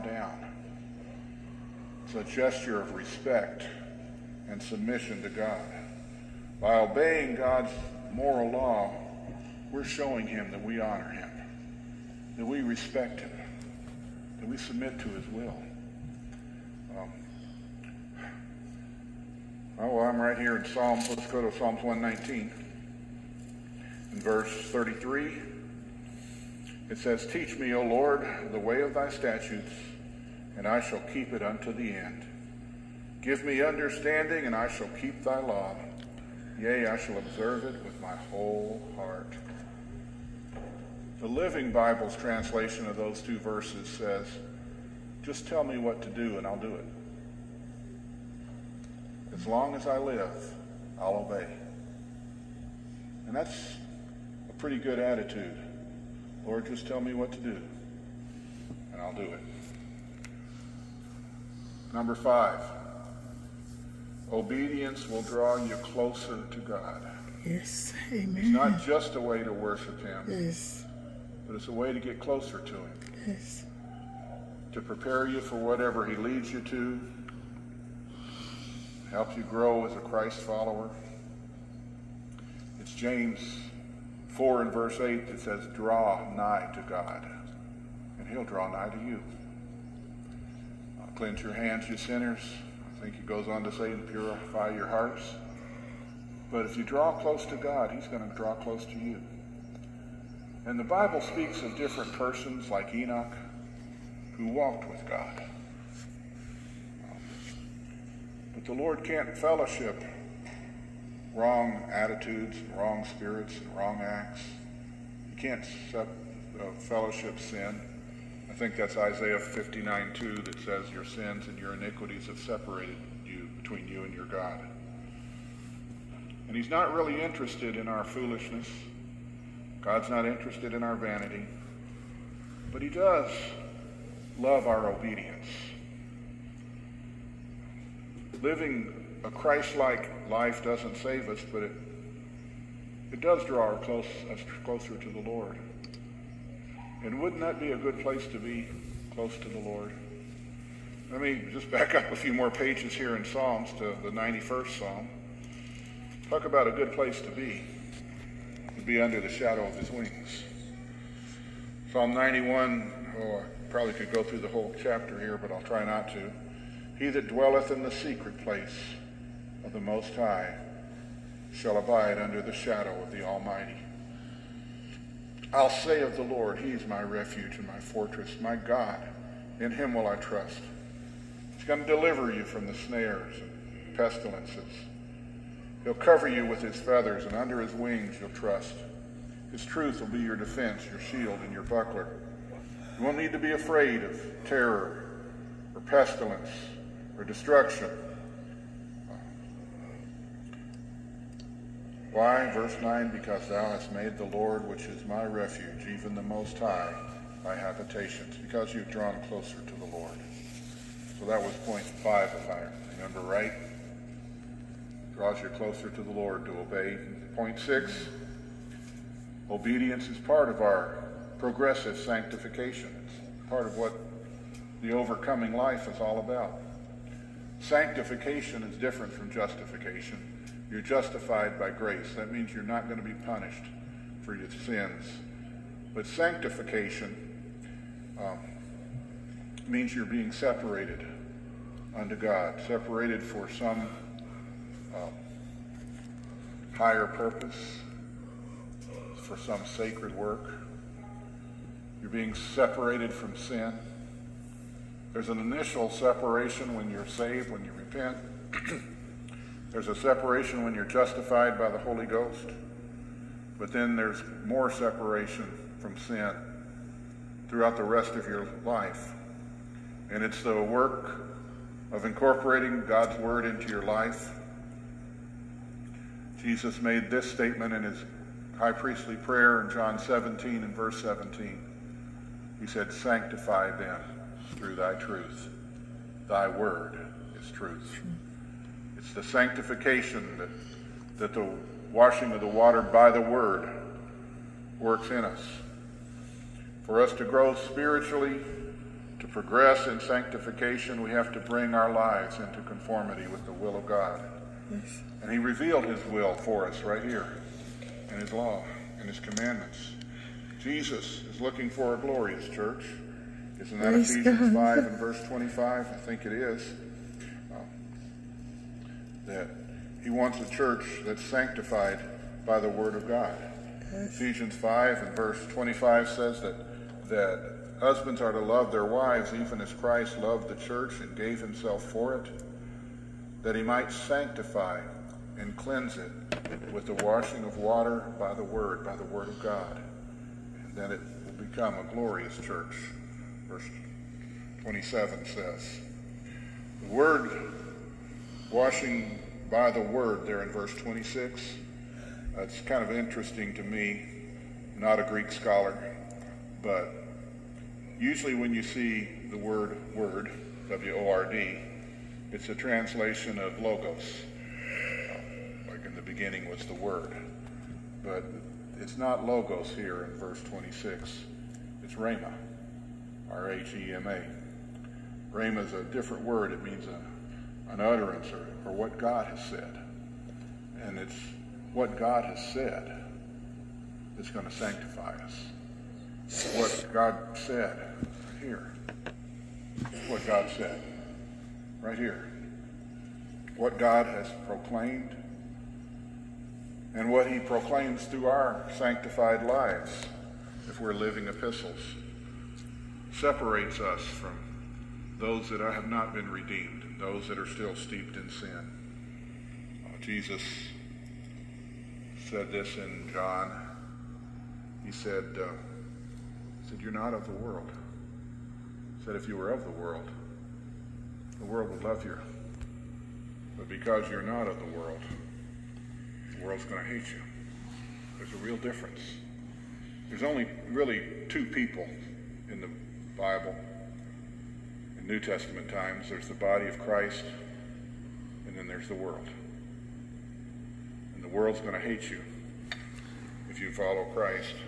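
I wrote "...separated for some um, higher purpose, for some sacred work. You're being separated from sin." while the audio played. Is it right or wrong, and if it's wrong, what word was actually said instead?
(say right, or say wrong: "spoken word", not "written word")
right.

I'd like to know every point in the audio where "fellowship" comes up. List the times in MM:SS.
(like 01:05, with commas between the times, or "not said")
01:49, 01:56.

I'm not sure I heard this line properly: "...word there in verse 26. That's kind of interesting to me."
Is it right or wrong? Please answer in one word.
right.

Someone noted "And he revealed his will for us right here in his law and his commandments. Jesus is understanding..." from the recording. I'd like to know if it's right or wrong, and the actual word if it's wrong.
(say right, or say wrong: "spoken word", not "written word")
wrong: "looking", not "understanding".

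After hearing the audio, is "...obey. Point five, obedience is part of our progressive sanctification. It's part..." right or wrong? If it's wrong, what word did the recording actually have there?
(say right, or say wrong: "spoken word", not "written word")
wrong: "six", not "five".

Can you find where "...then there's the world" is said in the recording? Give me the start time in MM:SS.
07:18.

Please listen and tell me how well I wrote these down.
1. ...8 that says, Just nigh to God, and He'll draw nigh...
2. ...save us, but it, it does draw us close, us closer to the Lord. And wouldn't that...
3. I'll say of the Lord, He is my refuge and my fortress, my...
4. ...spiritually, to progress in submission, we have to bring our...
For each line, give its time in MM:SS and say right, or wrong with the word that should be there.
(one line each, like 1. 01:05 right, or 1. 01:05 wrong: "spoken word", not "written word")
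1. 01:24 wrong: "Draw", not "Just"
2. 02:20 right
3. 02:55 right
4. 04:57 wrong: "sanctification", not "submission".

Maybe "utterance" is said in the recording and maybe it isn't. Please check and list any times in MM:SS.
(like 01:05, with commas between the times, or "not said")
06:17.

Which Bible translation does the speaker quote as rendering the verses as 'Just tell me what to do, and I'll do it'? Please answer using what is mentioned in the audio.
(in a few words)
The Living Bible.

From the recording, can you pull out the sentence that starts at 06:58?
He said, If you were of the world, the world would love you.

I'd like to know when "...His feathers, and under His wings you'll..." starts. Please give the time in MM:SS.
03:06.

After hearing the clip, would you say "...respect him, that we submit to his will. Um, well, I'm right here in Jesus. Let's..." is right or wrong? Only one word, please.
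wrong.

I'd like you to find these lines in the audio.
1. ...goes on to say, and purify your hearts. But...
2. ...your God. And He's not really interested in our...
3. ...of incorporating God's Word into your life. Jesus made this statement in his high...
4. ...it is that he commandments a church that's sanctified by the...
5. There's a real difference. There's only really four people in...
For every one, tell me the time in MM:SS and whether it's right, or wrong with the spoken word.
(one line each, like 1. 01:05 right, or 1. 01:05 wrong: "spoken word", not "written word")
1. 01:33 right
2. 02:04 right
3. 04:31 right
4. 05:16 wrong: "wants", not "commandments"
5. 07:08 wrong: "two", not "four".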